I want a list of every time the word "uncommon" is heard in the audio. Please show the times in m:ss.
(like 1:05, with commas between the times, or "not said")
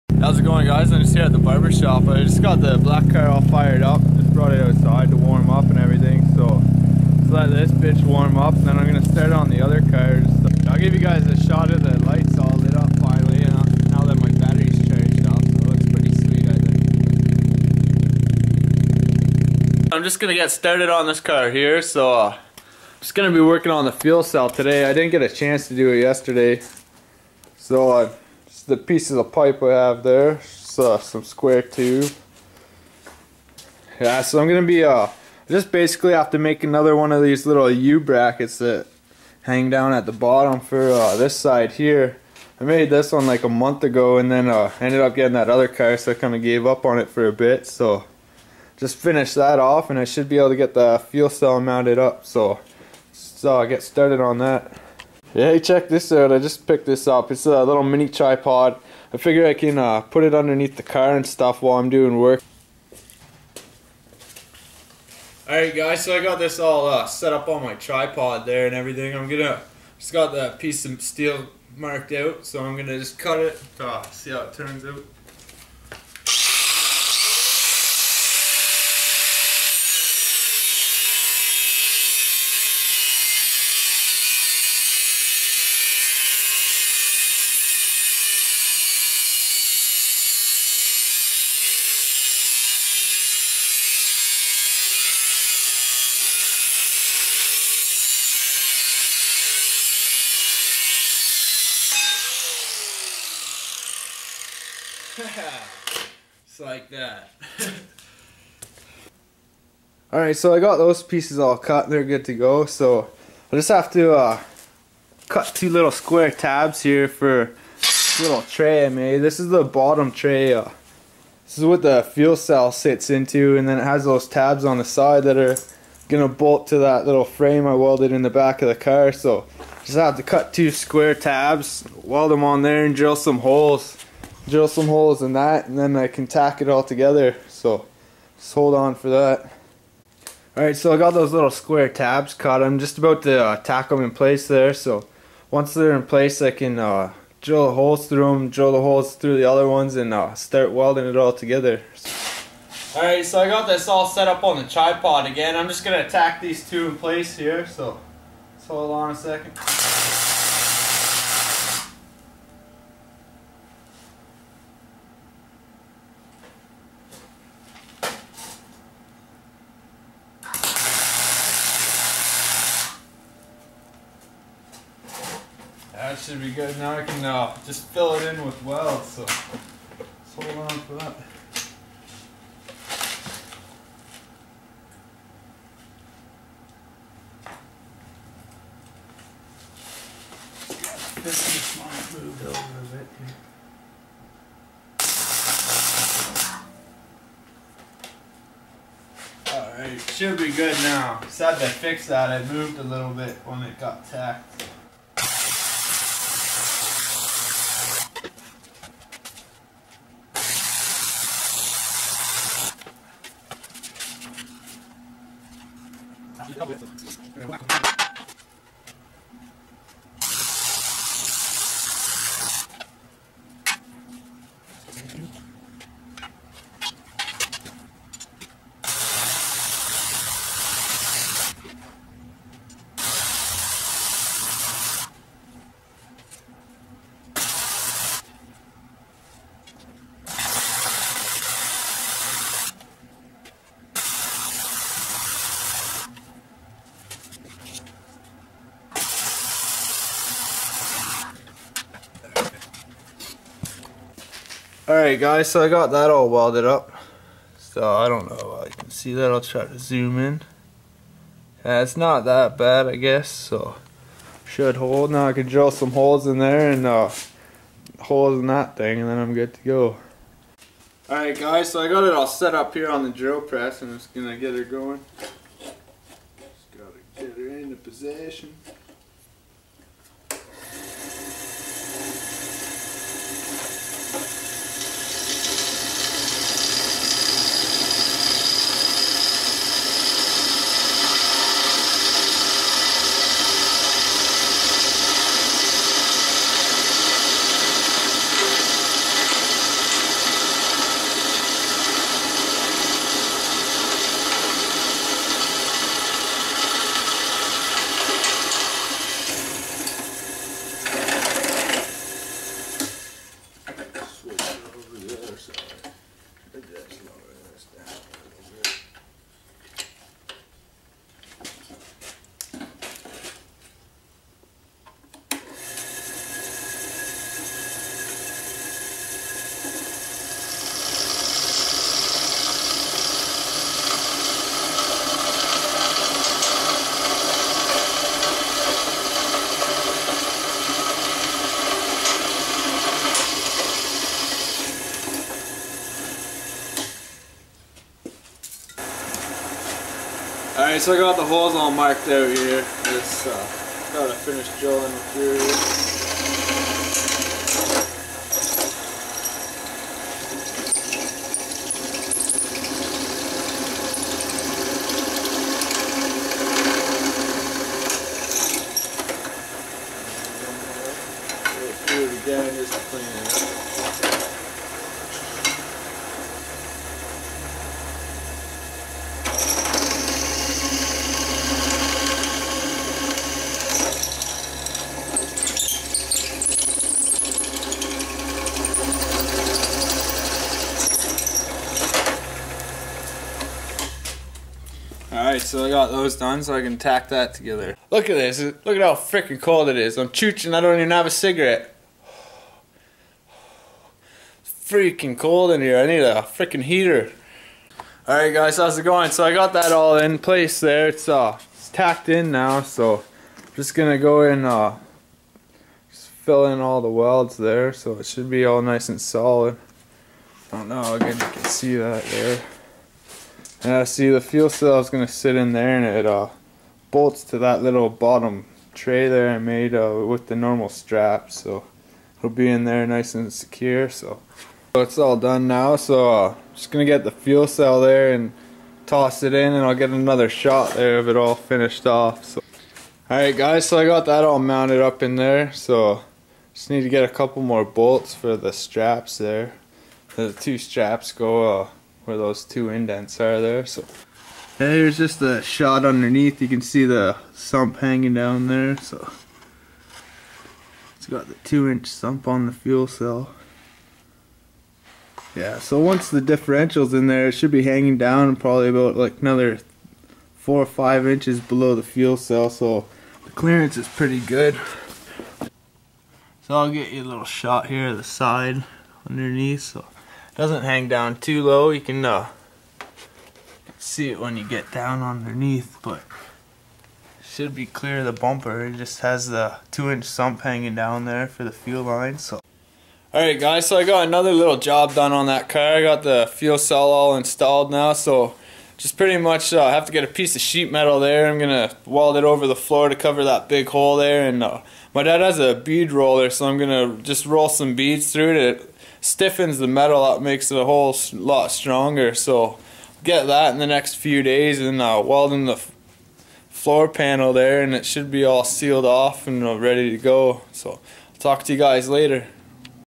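not said.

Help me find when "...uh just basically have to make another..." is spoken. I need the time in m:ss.
0:34.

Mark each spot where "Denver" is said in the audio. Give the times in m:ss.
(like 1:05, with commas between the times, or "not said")
not said.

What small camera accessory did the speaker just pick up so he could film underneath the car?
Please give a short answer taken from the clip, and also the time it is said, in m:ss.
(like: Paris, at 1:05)
mini tripod, at 0:57.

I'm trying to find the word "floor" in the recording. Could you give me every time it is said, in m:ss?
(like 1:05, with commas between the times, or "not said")
8:22, 8:36.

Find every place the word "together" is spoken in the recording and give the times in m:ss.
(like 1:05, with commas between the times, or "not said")
2:16, 2:31, 6:37.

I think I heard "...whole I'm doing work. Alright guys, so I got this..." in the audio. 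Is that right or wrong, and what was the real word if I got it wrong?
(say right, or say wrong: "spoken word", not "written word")
wrong: "while", not "whole".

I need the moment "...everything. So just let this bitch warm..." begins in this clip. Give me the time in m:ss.
0:05.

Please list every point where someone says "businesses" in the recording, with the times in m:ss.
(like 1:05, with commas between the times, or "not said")
not said.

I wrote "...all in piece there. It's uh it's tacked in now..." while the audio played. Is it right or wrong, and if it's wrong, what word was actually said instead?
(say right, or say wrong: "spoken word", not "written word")
wrong: "place", not "piece".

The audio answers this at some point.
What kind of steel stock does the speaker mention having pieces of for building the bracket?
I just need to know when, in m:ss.
0:31.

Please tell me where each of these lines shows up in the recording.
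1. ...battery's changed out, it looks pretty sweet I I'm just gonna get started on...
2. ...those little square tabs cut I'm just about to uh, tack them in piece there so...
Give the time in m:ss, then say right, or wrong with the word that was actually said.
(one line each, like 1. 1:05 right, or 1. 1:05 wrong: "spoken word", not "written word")
1. 0:14 right
2. 2:21 wrong: "place", not "piece".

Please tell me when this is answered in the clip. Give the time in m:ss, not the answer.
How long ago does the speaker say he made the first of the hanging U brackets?
0:43.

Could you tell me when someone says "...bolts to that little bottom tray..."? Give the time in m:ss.
7:06.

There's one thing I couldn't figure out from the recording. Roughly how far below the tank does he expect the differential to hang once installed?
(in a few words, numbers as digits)
4 or 5 inches.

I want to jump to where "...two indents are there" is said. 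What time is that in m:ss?
7:32.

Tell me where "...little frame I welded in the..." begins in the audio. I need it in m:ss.
2:07.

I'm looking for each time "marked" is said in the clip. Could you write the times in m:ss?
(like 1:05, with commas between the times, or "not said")
1:11, 5:51.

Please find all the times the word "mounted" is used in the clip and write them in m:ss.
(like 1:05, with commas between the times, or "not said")
0:51, 7:24.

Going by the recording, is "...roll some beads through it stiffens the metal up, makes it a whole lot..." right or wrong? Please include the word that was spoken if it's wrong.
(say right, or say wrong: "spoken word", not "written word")
right.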